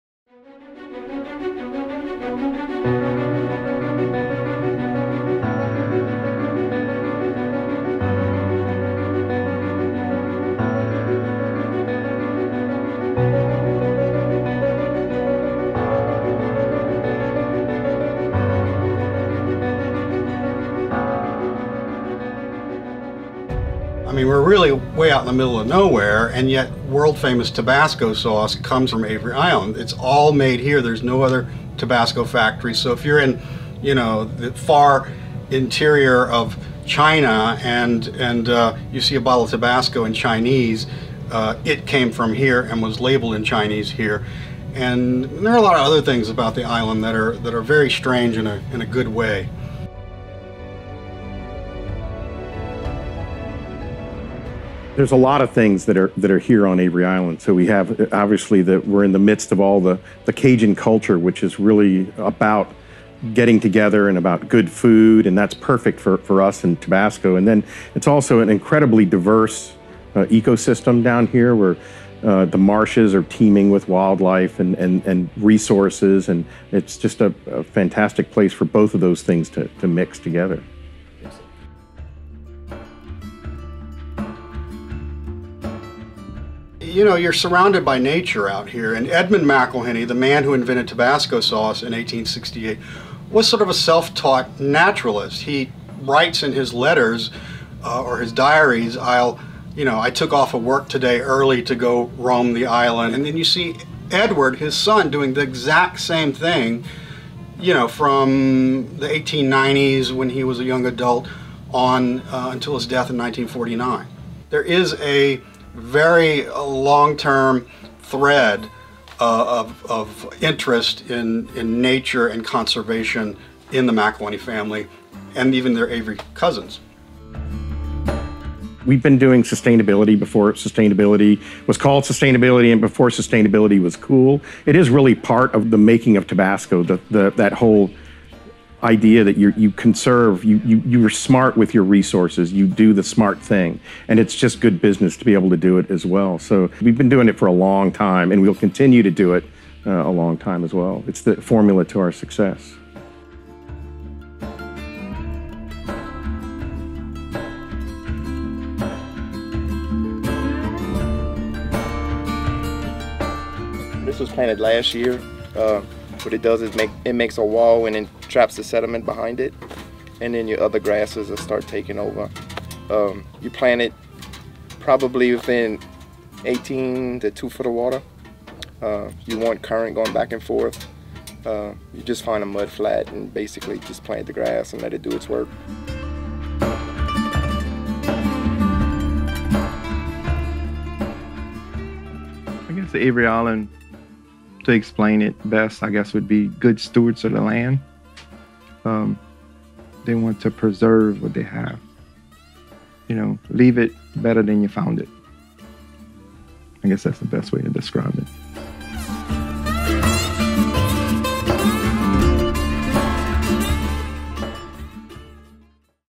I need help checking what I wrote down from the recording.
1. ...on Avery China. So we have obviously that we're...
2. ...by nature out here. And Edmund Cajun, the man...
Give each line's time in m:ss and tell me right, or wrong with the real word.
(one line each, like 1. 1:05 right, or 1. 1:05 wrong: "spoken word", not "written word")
1. 0:56 wrong: "Island", not "China"
2. 1:27 wrong: "McIlhenny", not "Cajun".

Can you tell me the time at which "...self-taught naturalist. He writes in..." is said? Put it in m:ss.
1:33.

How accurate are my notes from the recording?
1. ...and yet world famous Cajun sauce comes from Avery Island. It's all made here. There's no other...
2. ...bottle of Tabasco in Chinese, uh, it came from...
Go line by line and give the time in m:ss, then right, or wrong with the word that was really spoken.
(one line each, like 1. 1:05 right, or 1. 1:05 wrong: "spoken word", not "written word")
1. 0:26 wrong: "Tabasco", not "Cajun"
2. 0:39 right.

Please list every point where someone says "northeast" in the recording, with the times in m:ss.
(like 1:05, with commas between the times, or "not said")
not said.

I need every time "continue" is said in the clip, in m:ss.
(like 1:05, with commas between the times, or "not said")
2:28.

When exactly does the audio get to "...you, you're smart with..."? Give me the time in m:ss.
2:20.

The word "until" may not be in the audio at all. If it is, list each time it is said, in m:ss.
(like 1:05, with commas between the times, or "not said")
1:52.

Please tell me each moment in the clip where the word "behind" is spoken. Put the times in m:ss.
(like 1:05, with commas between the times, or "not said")
2:49.